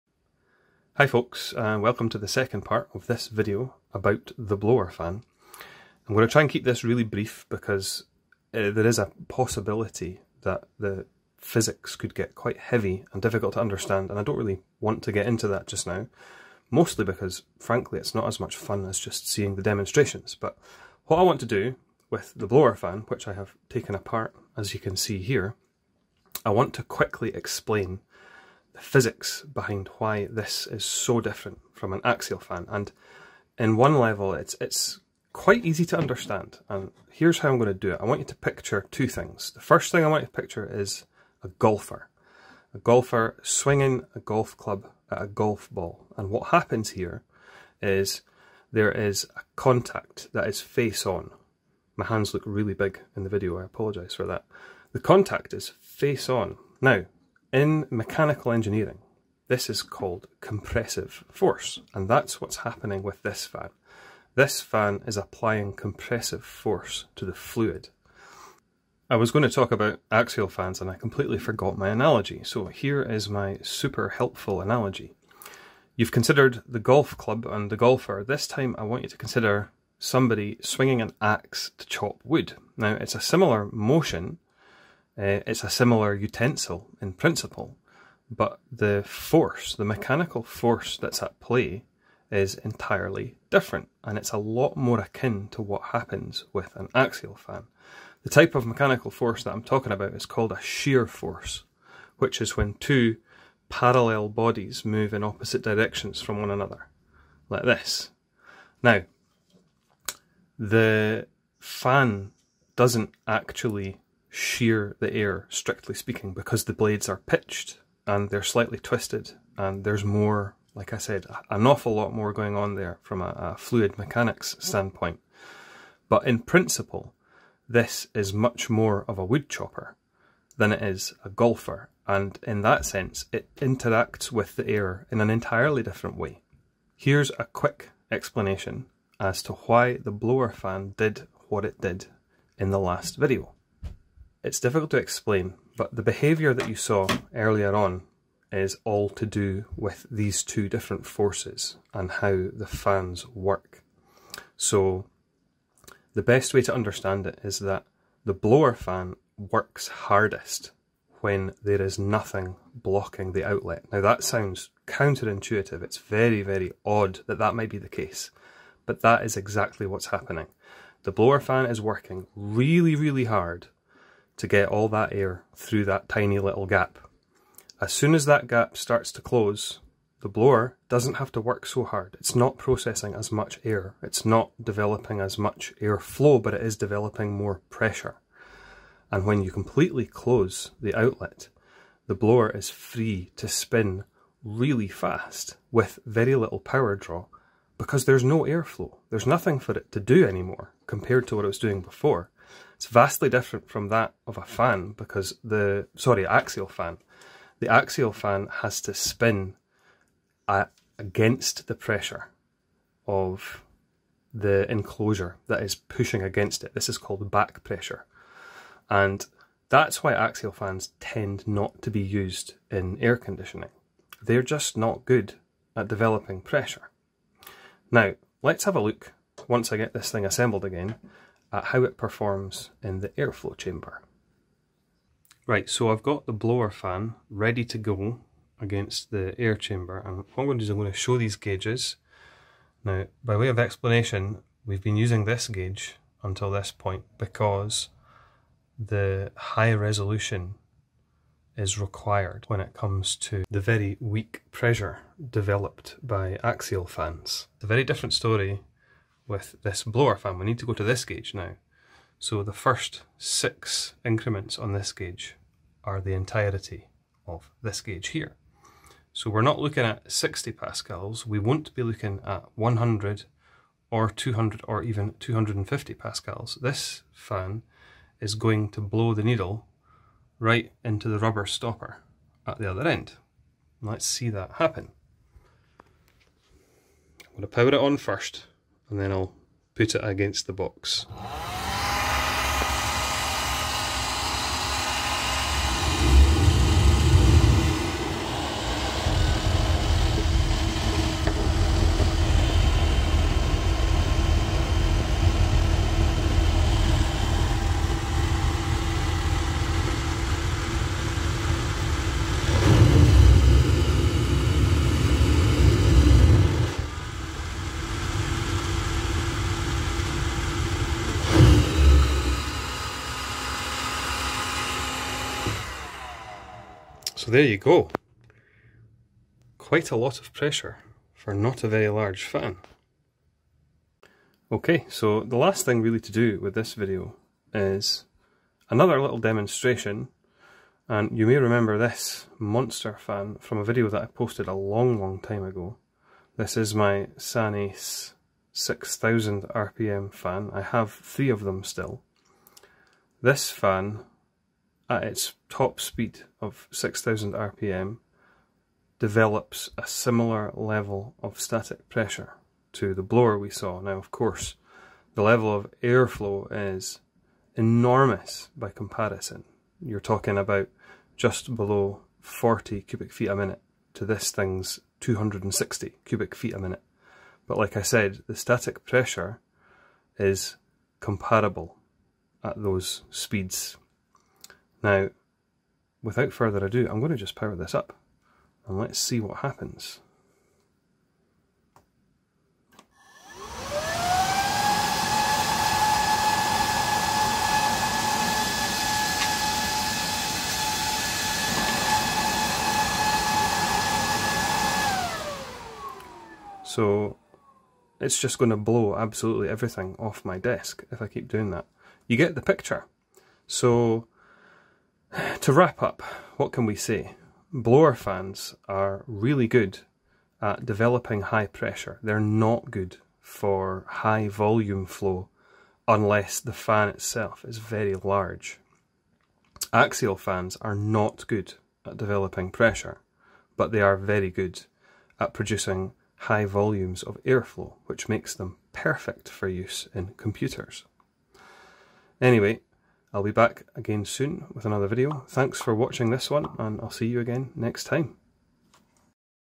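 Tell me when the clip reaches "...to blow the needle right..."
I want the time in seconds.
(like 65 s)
278 s.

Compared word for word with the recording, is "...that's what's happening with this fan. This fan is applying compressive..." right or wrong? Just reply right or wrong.
right.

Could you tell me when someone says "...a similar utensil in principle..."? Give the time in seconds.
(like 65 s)
85 s.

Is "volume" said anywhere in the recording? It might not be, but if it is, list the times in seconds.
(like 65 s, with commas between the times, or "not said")
424 s, 436 s.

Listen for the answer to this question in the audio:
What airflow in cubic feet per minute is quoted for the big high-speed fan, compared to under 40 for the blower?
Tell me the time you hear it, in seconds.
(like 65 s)
374 s.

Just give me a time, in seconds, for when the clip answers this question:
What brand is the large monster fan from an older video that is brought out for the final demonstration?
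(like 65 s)
347 s.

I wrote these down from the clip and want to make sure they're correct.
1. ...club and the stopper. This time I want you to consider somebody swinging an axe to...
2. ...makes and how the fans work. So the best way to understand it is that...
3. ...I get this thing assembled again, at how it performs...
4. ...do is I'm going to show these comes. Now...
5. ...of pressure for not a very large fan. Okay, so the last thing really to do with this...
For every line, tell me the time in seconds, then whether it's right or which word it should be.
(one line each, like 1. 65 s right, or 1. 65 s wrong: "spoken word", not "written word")
1. 77 s wrong: "golfer", not "stopper"
2. 151 s wrong: "forces", not "makes"
3. 229 s right
4. 240 s wrong: "gauges", not "comes"
5. 330 s right.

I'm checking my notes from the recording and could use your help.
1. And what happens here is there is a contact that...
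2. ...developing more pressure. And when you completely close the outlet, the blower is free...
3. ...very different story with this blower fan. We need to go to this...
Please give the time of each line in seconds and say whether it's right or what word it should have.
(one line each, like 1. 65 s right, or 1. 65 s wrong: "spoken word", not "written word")
1. 46 s right
2. 186 s right
3. 257 s right.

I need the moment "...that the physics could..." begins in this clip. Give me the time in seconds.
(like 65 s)
10 s.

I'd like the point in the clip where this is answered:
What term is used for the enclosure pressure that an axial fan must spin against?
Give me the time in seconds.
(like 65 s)
217 s.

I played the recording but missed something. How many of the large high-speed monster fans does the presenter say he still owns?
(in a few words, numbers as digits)
3.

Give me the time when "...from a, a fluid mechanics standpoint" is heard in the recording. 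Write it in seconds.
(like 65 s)
123 s.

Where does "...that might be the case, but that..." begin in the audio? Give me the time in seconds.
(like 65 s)
167 s.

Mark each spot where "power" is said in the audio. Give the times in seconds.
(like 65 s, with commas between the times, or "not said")
196 s, 287 s, 387 s.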